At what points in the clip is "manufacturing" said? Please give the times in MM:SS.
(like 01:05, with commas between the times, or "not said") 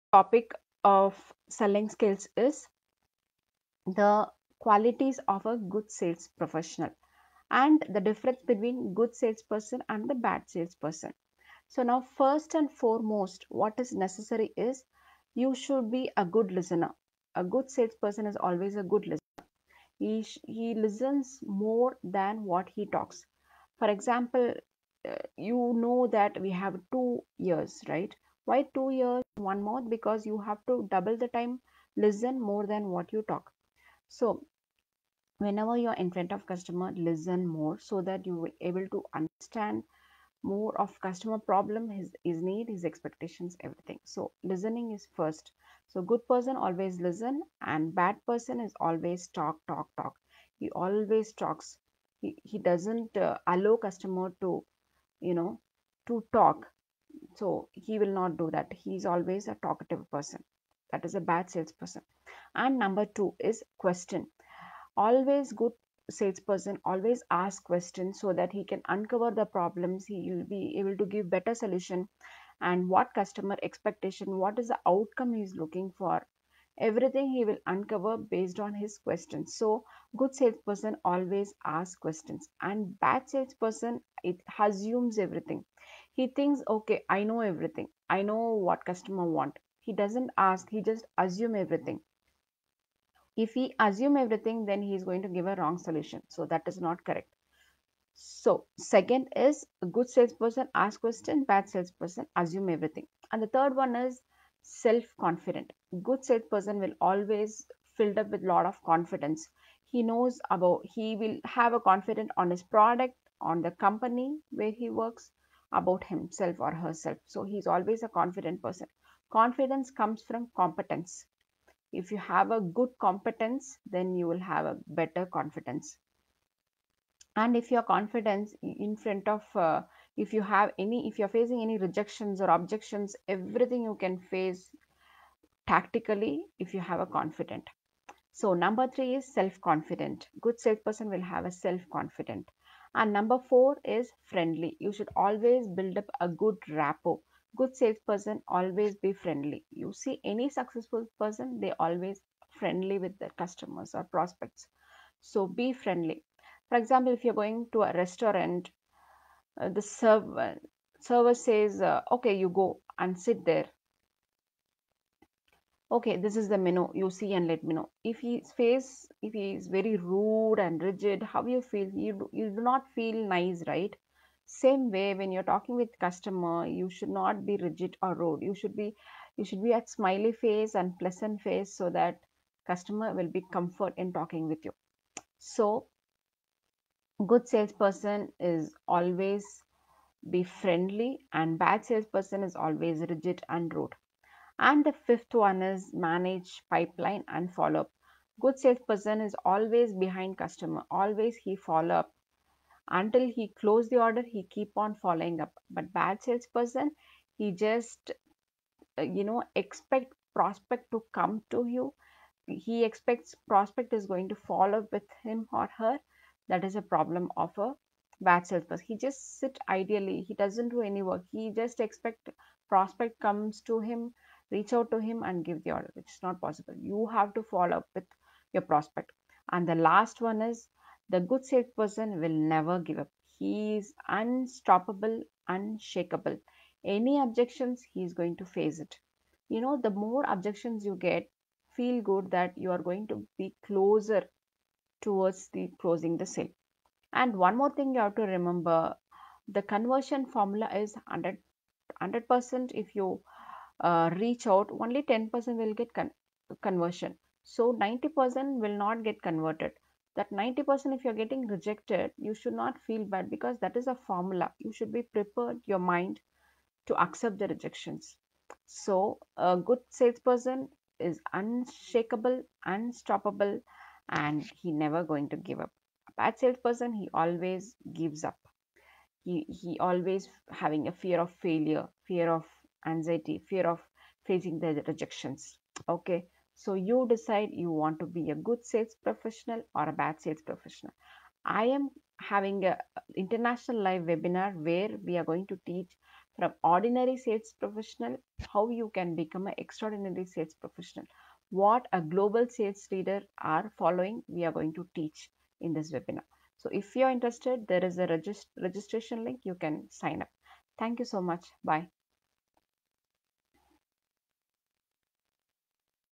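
not said.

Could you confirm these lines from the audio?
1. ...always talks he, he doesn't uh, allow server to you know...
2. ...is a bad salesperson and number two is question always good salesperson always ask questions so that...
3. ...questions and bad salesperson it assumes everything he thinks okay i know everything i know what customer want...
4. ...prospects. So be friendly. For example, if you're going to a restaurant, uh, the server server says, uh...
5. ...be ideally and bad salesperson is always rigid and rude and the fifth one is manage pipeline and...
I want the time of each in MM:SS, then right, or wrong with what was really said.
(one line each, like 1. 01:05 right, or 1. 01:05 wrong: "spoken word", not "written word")
1. 00:50 wrong: "customer", not "server"
2. 01:01 right
3. 01:21 right
4. 02:34 right
5. 03:10 wrong: "friendly", not "ideally".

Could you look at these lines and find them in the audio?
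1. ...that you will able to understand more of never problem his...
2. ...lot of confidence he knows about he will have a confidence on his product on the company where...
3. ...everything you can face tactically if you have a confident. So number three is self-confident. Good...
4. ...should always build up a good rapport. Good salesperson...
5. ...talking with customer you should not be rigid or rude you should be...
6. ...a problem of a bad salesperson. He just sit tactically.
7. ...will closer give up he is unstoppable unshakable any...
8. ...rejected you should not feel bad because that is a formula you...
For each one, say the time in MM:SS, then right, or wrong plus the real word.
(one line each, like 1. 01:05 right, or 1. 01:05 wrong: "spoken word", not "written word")
1. 00:38 wrong: "customer", not "never"
2. 01:48 right
3. 02:13 right
4. 02:24 right
5. 02:55 right
6. 03:36 wrong: "ideally", not "tactically"
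7. 03:52 wrong: "never", not "closer"
8. 04:21 right.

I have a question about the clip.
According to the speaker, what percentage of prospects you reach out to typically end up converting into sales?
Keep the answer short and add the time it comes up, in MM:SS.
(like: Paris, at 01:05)
10%, at 04:15.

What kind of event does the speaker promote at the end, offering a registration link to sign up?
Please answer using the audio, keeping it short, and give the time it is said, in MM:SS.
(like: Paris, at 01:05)
International live webinar, at 04:53.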